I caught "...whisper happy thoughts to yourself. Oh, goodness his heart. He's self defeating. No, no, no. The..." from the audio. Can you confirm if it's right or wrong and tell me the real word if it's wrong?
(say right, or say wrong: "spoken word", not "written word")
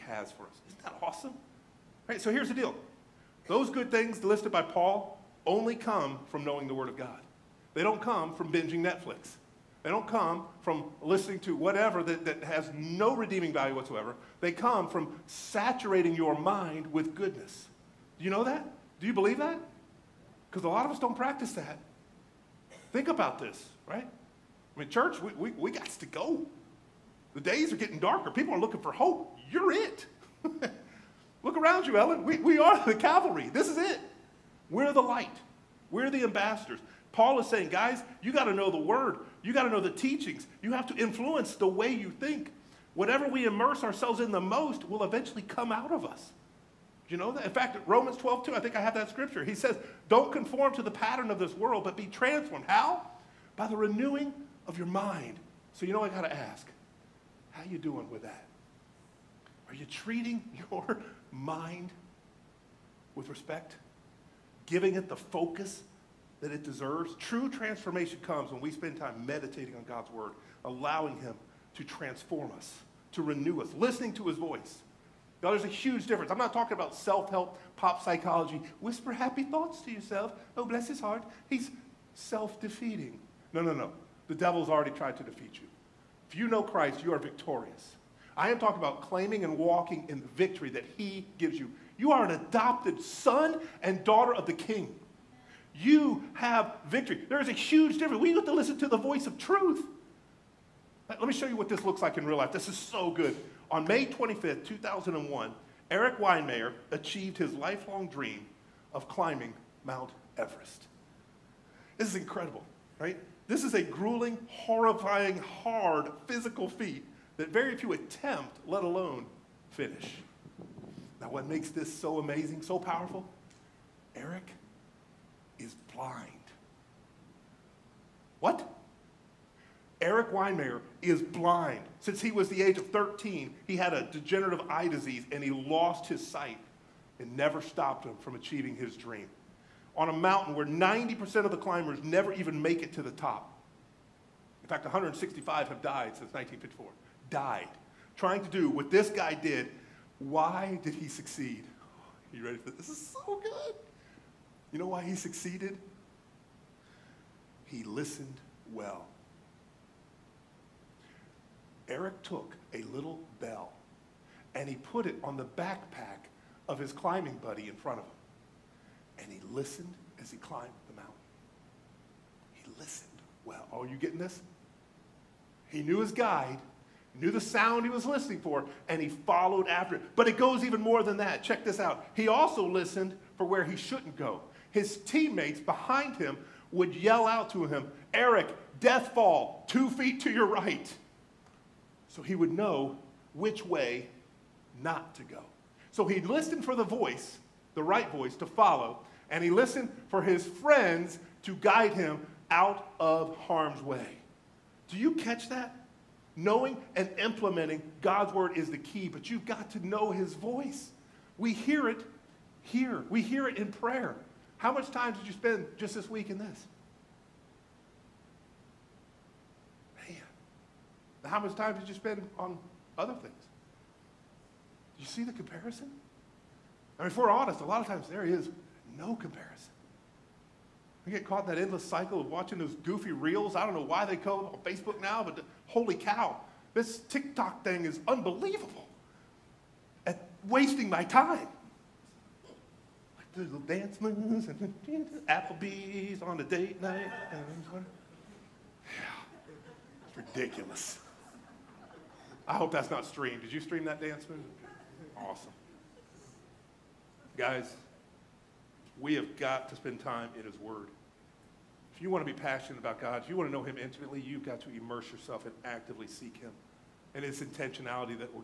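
wrong: "bless", not "goodness".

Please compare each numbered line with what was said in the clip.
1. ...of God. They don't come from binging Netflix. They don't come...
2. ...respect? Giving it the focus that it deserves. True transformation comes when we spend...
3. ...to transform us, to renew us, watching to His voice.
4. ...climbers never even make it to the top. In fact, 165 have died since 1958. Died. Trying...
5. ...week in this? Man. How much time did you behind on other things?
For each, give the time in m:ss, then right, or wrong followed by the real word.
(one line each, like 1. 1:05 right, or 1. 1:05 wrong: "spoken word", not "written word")
1. 0:06 right
2. 1:03 right
3. 1:11 wrong: "listening", not "watching"
4. 2:21 wrong: "1954", not "1958"
5. 3:36 wrong: "spend", not "behind".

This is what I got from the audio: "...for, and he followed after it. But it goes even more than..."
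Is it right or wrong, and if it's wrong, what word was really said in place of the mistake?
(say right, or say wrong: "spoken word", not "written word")
right.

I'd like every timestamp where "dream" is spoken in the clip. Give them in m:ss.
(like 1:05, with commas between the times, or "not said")
1:48, 2:18.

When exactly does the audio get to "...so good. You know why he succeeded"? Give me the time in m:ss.
2:33.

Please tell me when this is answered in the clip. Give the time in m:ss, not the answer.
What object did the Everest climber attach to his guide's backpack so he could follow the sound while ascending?
2:42.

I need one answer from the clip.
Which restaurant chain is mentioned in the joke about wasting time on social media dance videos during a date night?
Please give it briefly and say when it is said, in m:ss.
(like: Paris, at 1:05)
Applebee's, at 4:05.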